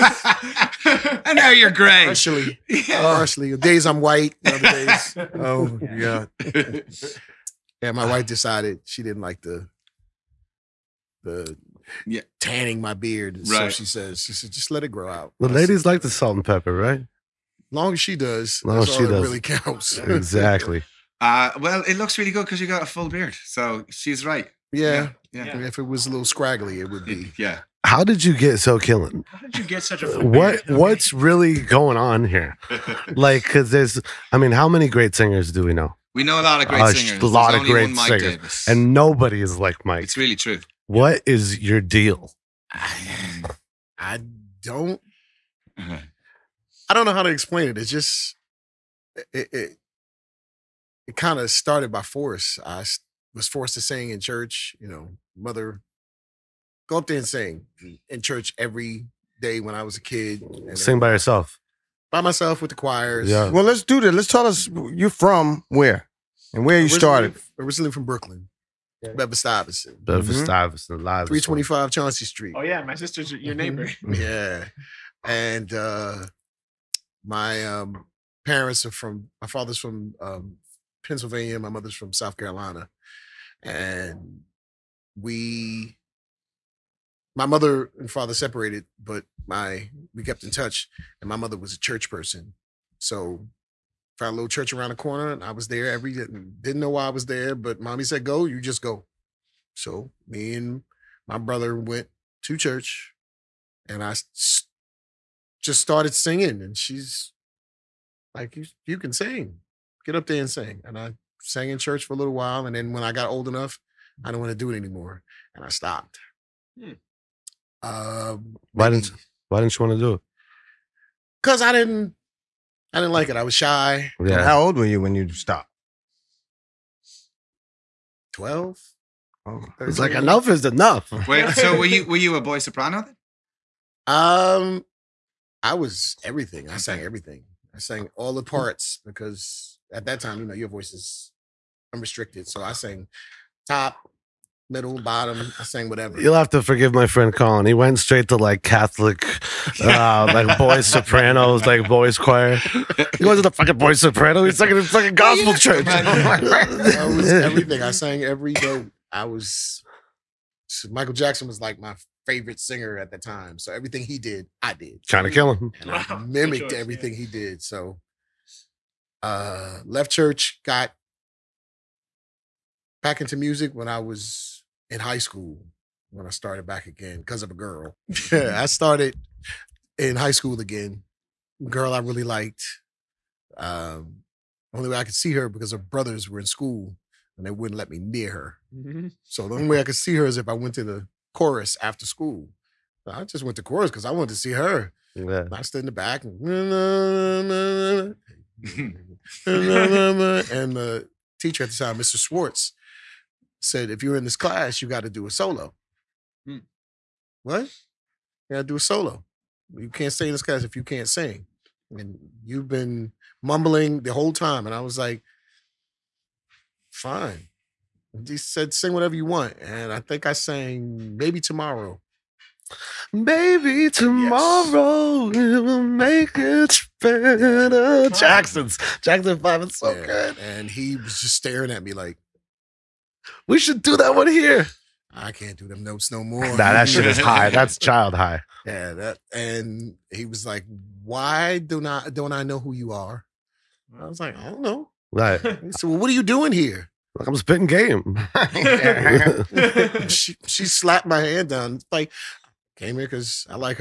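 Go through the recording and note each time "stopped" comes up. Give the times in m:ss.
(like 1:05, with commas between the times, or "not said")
1:55, 2:05.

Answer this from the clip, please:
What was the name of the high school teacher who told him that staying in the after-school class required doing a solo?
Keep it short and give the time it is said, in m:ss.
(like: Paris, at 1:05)
Mr. Schwartz, at 3:21.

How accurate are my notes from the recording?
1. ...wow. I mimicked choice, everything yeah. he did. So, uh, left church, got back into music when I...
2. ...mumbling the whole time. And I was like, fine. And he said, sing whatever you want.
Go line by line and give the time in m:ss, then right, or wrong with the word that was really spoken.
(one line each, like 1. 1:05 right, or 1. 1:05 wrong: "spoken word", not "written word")
1. 2:45 right
2. 3:33 right.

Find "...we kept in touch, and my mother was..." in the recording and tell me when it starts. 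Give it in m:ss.
1:30.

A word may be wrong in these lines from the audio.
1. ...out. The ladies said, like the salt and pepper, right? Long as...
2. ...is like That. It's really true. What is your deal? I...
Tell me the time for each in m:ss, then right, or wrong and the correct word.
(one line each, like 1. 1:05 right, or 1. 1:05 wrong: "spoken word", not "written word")
1. 0:15 right
2. 0:39 wrong: "Mike", not "That".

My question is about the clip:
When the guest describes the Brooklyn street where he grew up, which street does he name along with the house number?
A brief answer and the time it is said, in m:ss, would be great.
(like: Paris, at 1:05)
Chauncey Street, at 1:11.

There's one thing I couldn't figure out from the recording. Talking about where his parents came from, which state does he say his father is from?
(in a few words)
Pennsylvania.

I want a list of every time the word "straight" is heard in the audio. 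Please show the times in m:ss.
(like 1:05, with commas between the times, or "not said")
2:27.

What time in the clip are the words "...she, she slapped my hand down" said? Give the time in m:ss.
4:10.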